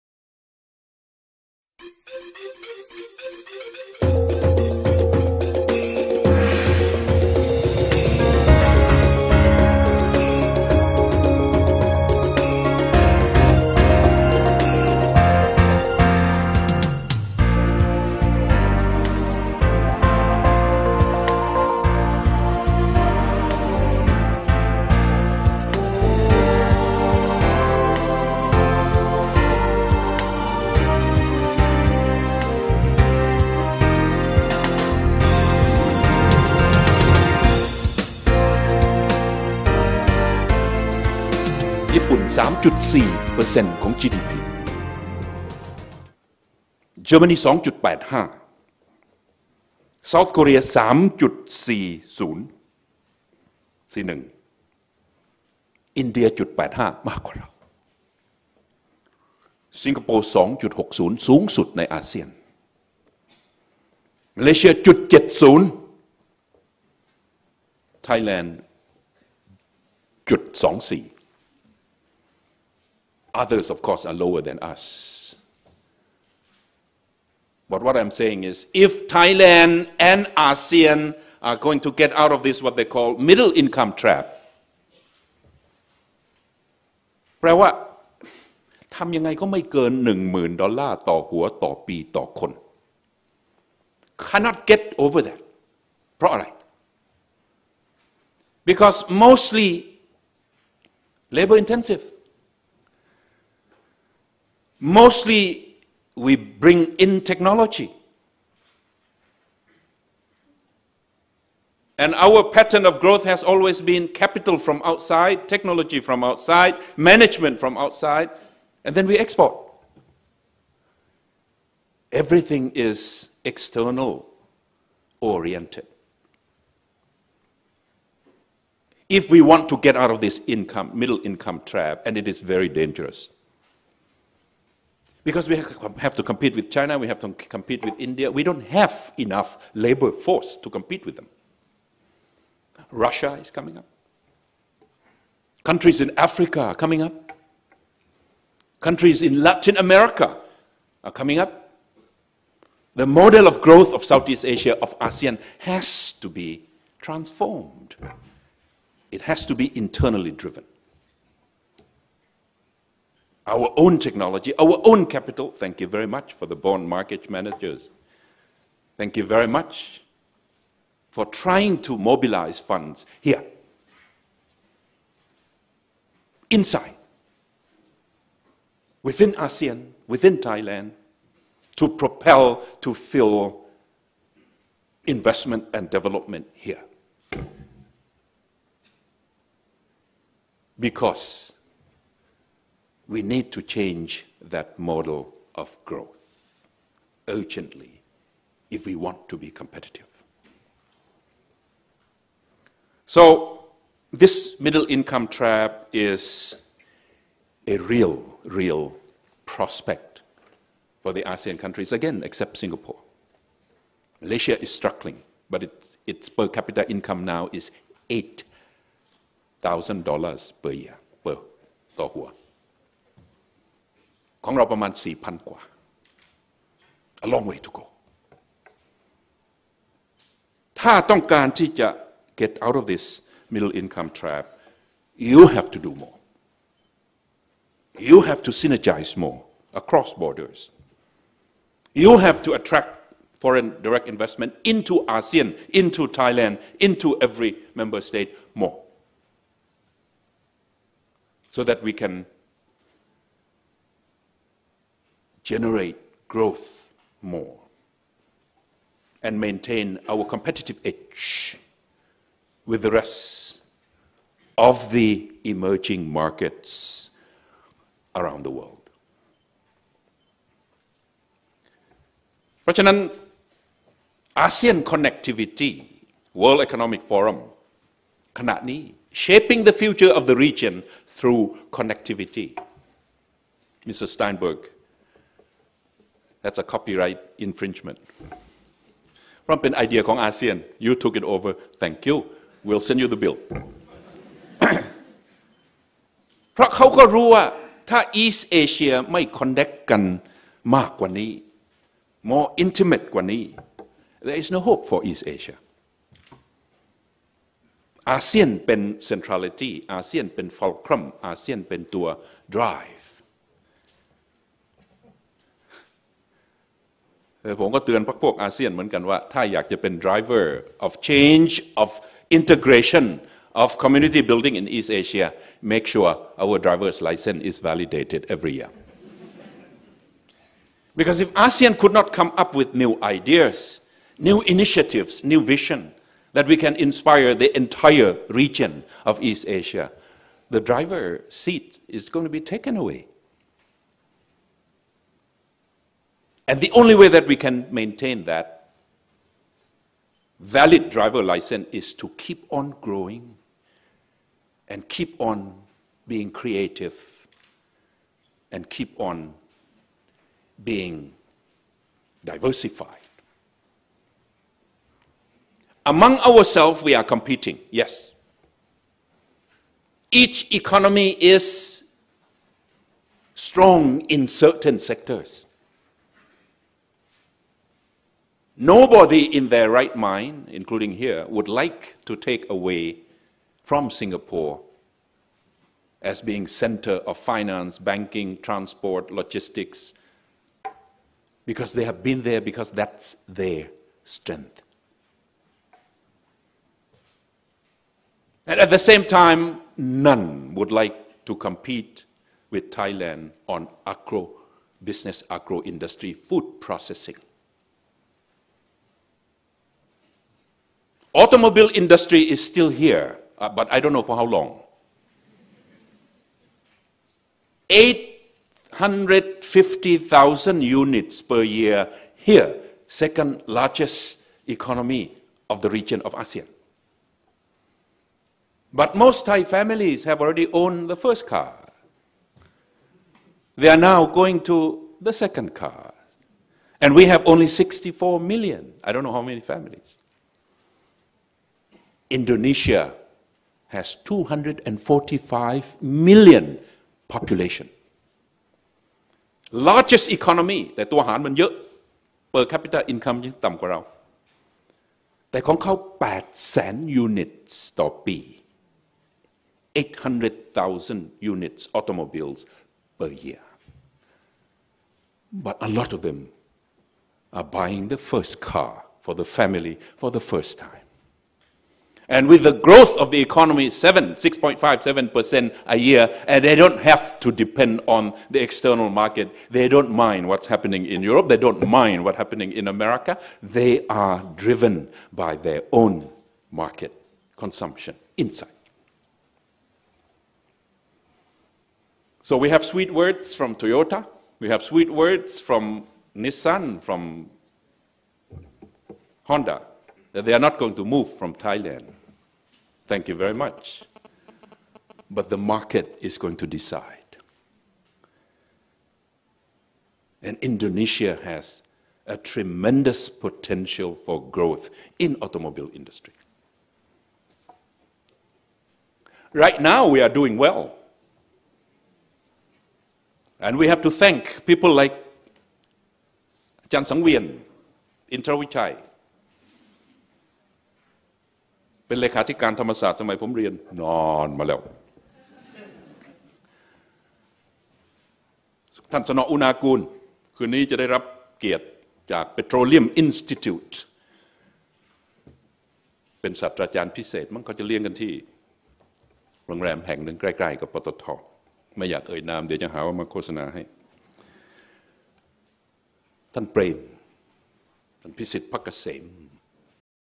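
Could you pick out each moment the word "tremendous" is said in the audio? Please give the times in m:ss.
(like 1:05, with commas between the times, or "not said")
8:32.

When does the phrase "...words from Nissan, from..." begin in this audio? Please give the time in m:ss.
8:14.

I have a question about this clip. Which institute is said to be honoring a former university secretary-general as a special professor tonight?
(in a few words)
Petroleum Institute.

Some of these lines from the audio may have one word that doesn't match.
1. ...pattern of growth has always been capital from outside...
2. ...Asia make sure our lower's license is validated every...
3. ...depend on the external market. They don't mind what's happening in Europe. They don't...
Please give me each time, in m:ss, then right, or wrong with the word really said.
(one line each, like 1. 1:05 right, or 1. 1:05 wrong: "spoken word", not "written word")
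1. 1:52 right
2. 5:25 wrong: "driver", not "lower"
3. 7:57 right.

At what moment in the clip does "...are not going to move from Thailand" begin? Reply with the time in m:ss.
8:20.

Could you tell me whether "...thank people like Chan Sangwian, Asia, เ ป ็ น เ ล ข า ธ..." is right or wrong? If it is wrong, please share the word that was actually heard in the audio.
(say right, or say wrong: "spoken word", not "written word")
wrong: "Intrawichai", not "Asia".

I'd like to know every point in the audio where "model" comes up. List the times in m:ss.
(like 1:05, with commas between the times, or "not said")
2:33, 3:14.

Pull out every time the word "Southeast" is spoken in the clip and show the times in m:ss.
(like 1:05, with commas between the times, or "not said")
2:34.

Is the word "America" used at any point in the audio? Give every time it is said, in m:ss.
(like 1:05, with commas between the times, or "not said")
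2:29, 8:02.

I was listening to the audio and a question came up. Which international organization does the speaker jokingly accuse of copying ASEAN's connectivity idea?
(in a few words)
World Economic Forum.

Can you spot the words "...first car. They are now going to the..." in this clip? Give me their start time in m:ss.
7:10.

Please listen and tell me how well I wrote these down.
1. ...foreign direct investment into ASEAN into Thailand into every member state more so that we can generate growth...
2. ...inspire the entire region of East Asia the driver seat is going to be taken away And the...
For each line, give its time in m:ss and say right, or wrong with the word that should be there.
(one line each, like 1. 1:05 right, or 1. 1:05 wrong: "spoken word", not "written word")
1. 4:03 right
2. 5:36 right.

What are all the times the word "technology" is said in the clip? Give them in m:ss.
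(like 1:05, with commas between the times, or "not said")
1:47, 1:55, 2:43.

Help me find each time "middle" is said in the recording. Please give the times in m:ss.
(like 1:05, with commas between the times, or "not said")
1:23, 2:10, 3:24, 3:53.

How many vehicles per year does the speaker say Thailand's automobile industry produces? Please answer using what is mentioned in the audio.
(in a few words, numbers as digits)
850,000.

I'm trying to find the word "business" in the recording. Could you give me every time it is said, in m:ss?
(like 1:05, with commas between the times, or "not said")
6:44.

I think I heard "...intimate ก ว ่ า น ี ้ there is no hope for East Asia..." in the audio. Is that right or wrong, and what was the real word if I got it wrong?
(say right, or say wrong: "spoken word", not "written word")
right.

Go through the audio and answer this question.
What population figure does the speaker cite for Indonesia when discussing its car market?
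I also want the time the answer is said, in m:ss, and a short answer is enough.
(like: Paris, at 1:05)
245 million, at 7:24.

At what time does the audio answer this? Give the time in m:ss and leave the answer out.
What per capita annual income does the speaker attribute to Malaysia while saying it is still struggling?
3:38.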